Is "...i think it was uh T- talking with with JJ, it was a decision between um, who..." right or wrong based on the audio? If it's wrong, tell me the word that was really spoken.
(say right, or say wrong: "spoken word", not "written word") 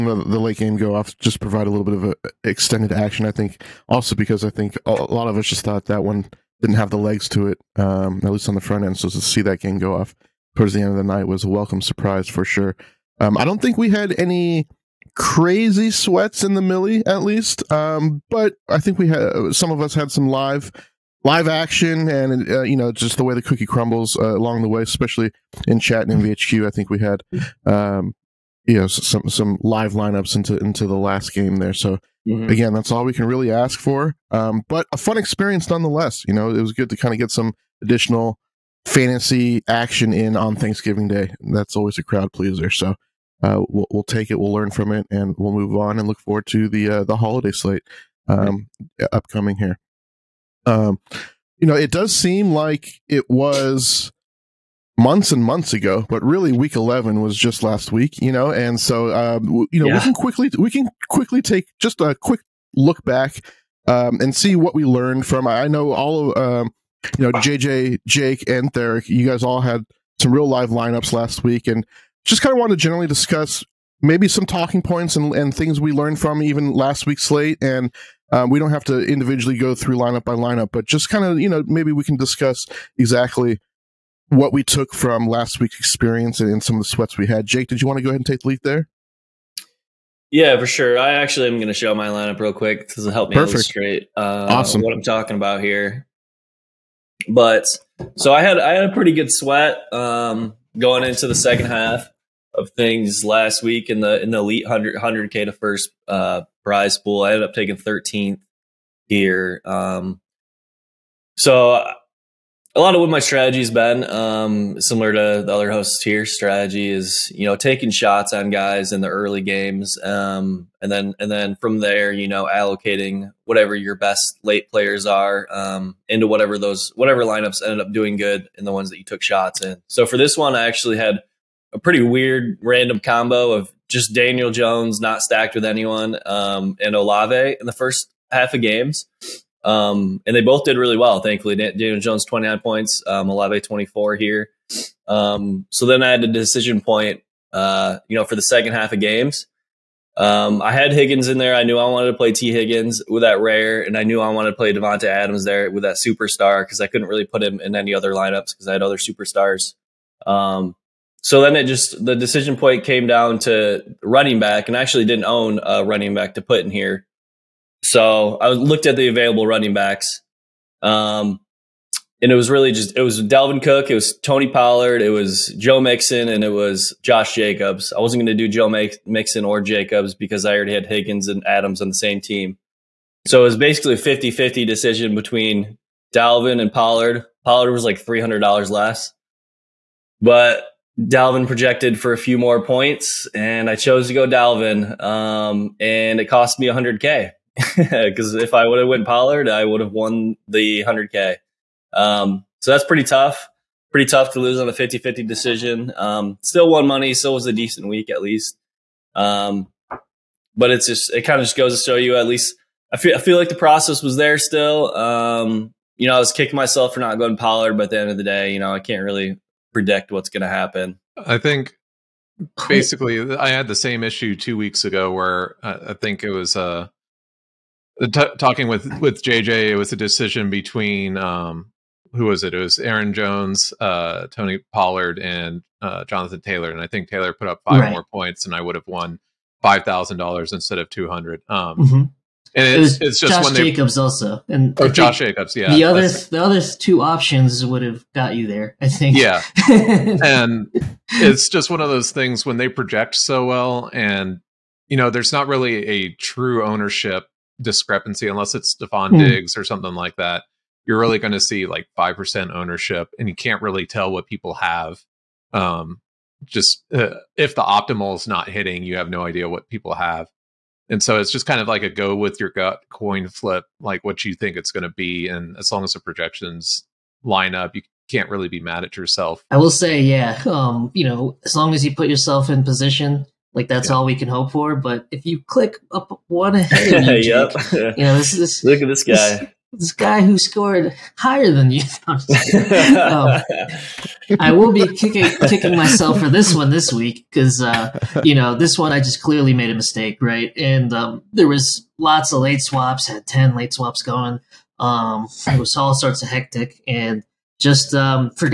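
right.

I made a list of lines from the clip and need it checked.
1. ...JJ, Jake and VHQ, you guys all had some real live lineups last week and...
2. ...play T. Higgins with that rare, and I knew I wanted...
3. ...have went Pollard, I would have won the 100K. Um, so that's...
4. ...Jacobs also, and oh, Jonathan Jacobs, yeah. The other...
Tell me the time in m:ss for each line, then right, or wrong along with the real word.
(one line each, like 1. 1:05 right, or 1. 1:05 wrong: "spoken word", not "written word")
1. 1:07 wrong: "Theric", not "VHQ"
2. 2:32 right
3. 3:18 right
4. 4:03 wrong: "Josh", not "Jonathan".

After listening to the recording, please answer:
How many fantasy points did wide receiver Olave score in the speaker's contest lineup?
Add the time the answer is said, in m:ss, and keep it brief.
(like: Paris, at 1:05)
24, at 2:23.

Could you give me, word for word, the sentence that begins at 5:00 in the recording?
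And um, there was lots of late swaps, had ten late swaps going.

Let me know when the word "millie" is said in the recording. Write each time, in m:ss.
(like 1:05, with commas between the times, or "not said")
0:16.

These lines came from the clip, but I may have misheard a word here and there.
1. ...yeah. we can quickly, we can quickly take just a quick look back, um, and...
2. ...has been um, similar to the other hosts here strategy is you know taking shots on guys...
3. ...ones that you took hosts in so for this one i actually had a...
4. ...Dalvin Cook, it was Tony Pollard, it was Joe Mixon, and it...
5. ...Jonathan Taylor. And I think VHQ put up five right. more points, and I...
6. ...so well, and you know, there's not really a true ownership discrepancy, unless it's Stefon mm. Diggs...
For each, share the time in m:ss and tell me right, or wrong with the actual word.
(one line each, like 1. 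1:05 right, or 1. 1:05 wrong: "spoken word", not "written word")
1. 0:59 right
2. 1:53 right
3. 2:08 wrong: "shots", not "hosts"
4. 2:53 right
5. 3:56 wrong: "Taylor", not "VHQ"
6. 4:13 right.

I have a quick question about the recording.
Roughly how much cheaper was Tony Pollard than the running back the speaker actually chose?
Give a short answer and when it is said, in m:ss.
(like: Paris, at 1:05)
$300, at 3:08.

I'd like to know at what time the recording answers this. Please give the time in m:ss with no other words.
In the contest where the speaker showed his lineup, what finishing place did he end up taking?
1:47.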